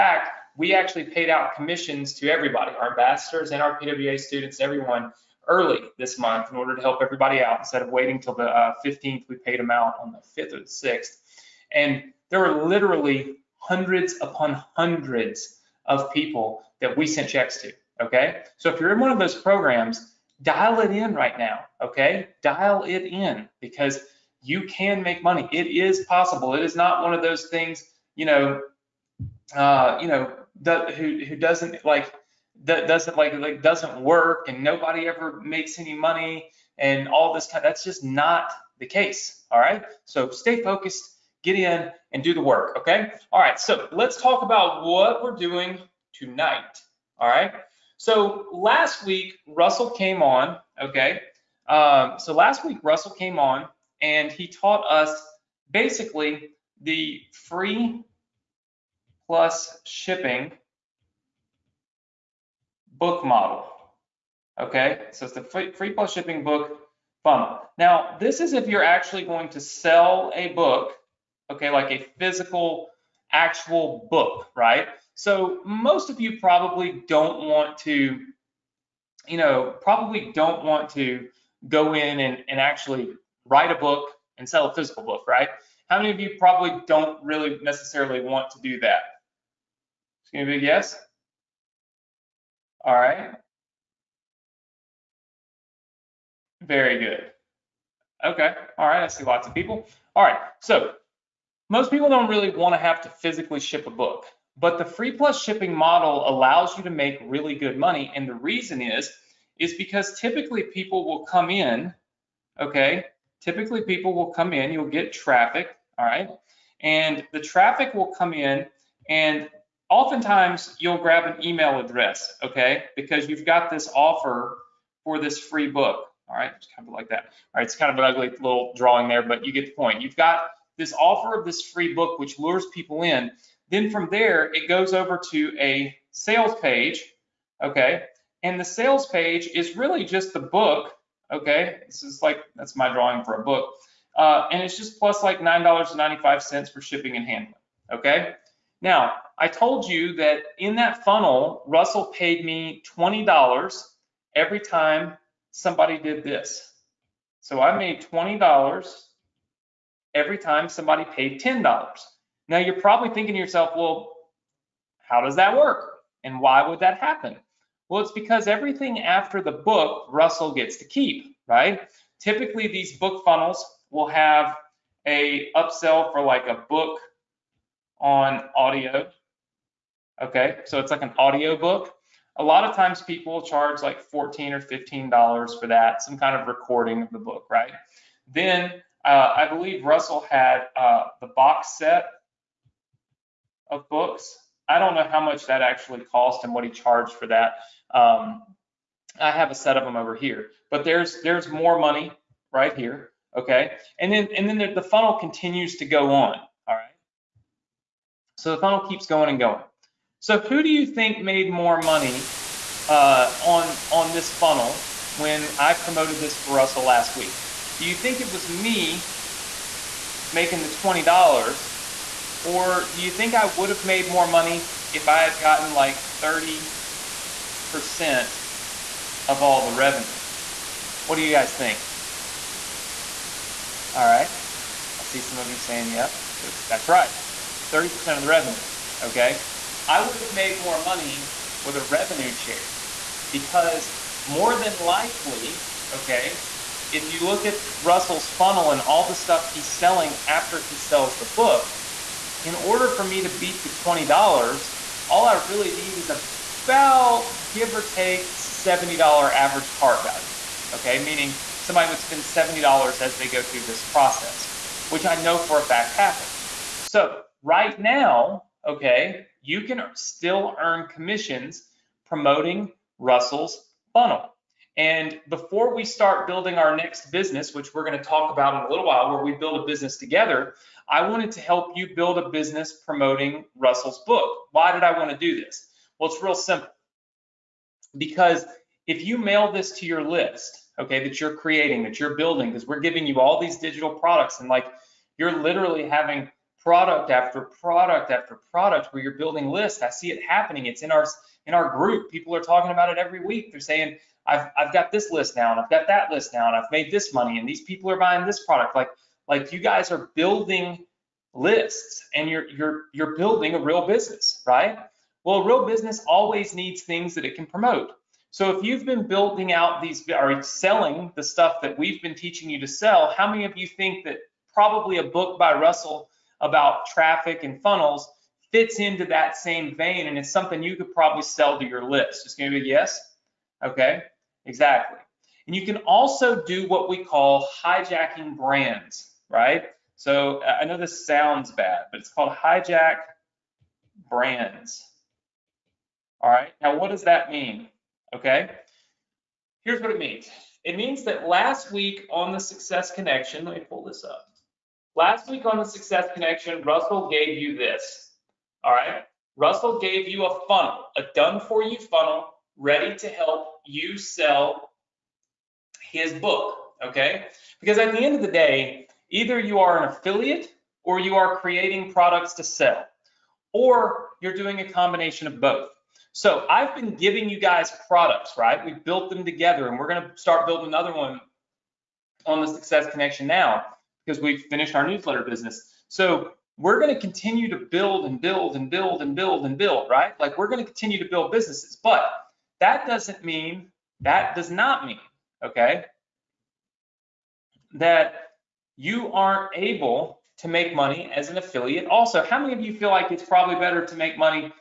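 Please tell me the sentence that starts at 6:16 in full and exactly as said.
So I've been giving you guys products, right?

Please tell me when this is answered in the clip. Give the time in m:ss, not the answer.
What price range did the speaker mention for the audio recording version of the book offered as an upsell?
3:04.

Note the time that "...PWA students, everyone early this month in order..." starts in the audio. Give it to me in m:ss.
0:03.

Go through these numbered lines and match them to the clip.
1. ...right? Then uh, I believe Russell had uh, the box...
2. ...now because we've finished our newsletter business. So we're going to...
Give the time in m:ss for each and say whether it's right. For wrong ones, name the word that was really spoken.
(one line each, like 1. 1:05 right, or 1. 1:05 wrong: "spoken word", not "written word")
1. 3:07 right
2. 6:23 right.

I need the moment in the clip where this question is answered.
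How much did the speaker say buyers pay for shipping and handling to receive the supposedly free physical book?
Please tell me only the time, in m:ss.
2:25.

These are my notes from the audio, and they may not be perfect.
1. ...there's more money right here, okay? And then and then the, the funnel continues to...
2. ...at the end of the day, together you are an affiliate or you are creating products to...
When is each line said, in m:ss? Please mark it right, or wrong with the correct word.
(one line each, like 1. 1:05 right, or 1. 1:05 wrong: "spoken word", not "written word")
1. 3:21 right
2. 6:07 wrong: "either", not "together".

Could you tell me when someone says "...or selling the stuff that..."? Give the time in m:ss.
5:20.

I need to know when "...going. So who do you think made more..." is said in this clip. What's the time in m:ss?
3:29.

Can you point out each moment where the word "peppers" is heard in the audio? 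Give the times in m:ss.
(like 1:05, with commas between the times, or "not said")
not said.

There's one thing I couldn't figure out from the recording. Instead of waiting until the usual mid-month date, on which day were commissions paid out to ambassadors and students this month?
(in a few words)
5th or 6th.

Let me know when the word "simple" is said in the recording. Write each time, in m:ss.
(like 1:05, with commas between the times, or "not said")
4:46.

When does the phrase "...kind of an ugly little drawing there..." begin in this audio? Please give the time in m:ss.
2:07.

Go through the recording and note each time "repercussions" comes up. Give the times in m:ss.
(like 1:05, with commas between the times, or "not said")
not said.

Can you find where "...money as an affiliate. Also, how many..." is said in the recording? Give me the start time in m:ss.
6:40.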